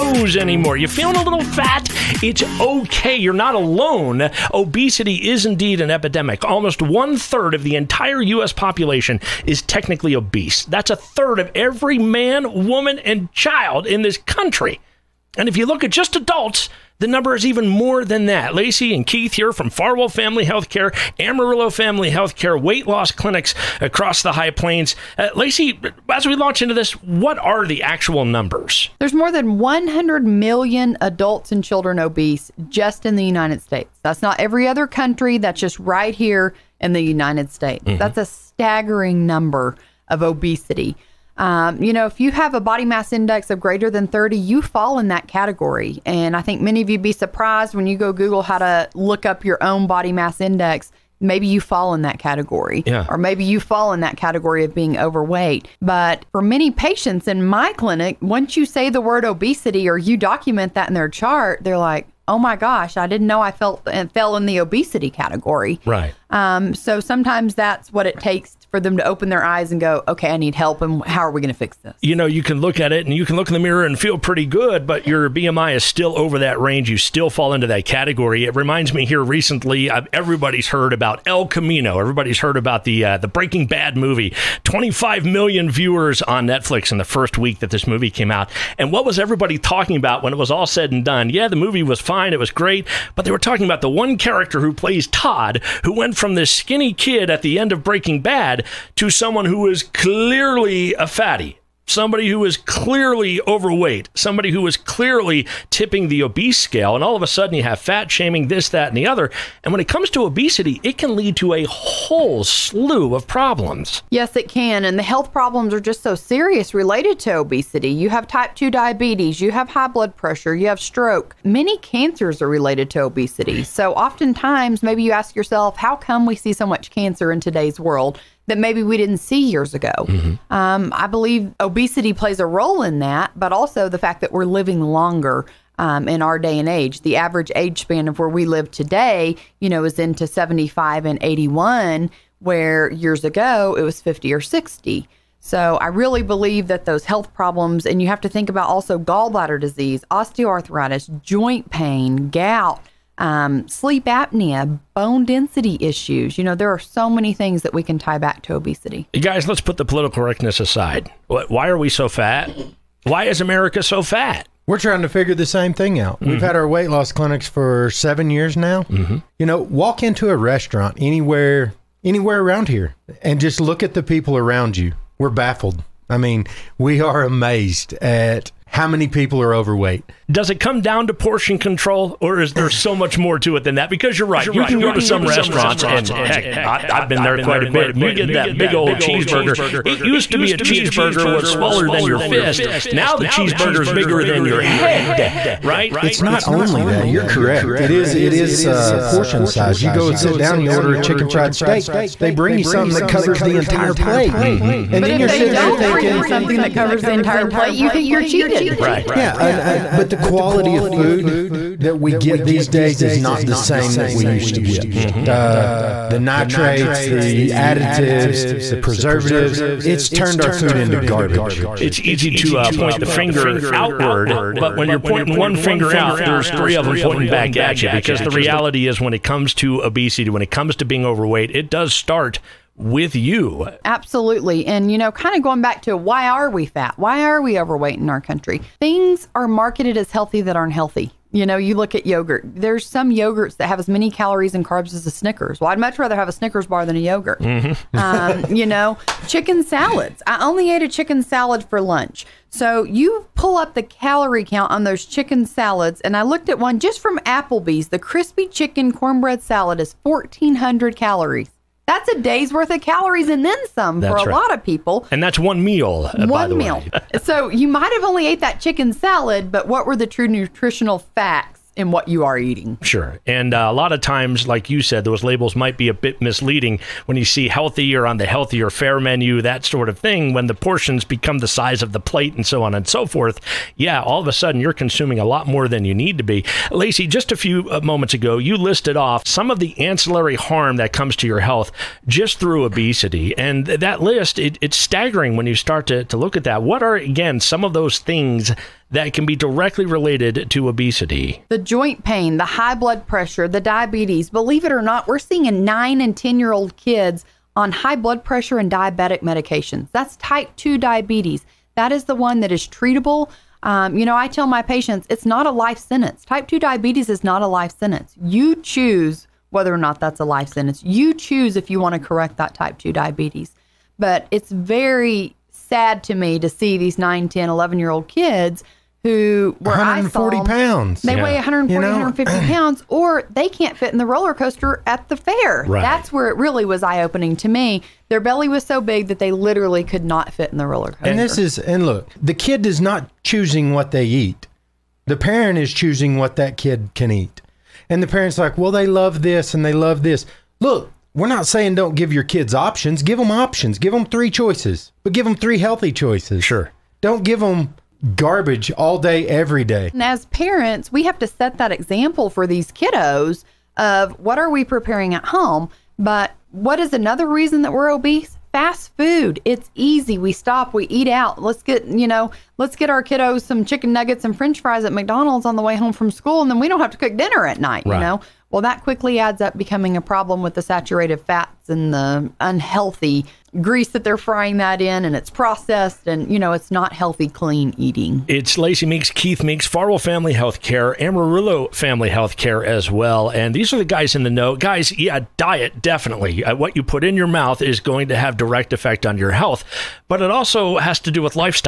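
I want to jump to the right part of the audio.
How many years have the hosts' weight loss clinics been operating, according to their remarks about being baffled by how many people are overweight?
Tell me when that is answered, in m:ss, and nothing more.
2:47.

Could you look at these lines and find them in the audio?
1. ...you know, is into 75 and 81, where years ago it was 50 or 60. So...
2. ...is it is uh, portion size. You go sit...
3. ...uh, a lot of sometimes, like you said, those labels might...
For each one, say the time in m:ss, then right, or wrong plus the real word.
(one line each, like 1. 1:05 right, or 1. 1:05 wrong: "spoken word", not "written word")
1. 2:19 right
2. 3:17 right
3. 4:33 wrong: "times", not "sometimes".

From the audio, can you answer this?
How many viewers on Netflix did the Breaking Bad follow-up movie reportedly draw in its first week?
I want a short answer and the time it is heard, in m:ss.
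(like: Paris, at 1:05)
25 million, at 1:24.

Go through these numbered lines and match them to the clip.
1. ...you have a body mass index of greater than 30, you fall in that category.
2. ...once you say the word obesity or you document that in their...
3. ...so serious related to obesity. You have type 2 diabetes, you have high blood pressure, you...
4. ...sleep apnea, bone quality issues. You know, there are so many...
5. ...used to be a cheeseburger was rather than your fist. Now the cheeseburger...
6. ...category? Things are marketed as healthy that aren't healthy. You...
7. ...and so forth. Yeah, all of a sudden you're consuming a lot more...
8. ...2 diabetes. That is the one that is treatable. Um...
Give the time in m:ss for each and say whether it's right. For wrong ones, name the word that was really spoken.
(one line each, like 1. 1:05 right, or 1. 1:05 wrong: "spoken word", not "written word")
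1. 0:42 right
2. 0:58 right
3. 1:56 right
4. 2:33 wrong: "density", not "quality"
5. 3:10 wrong: "smaller", not "rather"
6. 3:58 wrong: "country", not "category"
7. 4:42 right
8. 5:10 right.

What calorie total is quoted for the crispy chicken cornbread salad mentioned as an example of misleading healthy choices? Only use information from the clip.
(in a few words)
1,400.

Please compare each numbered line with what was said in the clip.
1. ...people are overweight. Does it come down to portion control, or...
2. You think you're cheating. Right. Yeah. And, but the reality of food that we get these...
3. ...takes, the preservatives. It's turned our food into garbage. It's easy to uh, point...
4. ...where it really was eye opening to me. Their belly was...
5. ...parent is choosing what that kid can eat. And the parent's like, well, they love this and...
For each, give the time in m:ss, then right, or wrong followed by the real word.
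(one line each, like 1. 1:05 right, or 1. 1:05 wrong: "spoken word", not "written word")
1. 2:59 right
2. 3:27 wrong: "quality", not "reality"
3. 3:37 wrong: "additives", not "takes"
4. 5:36 right
5. 5:45 right.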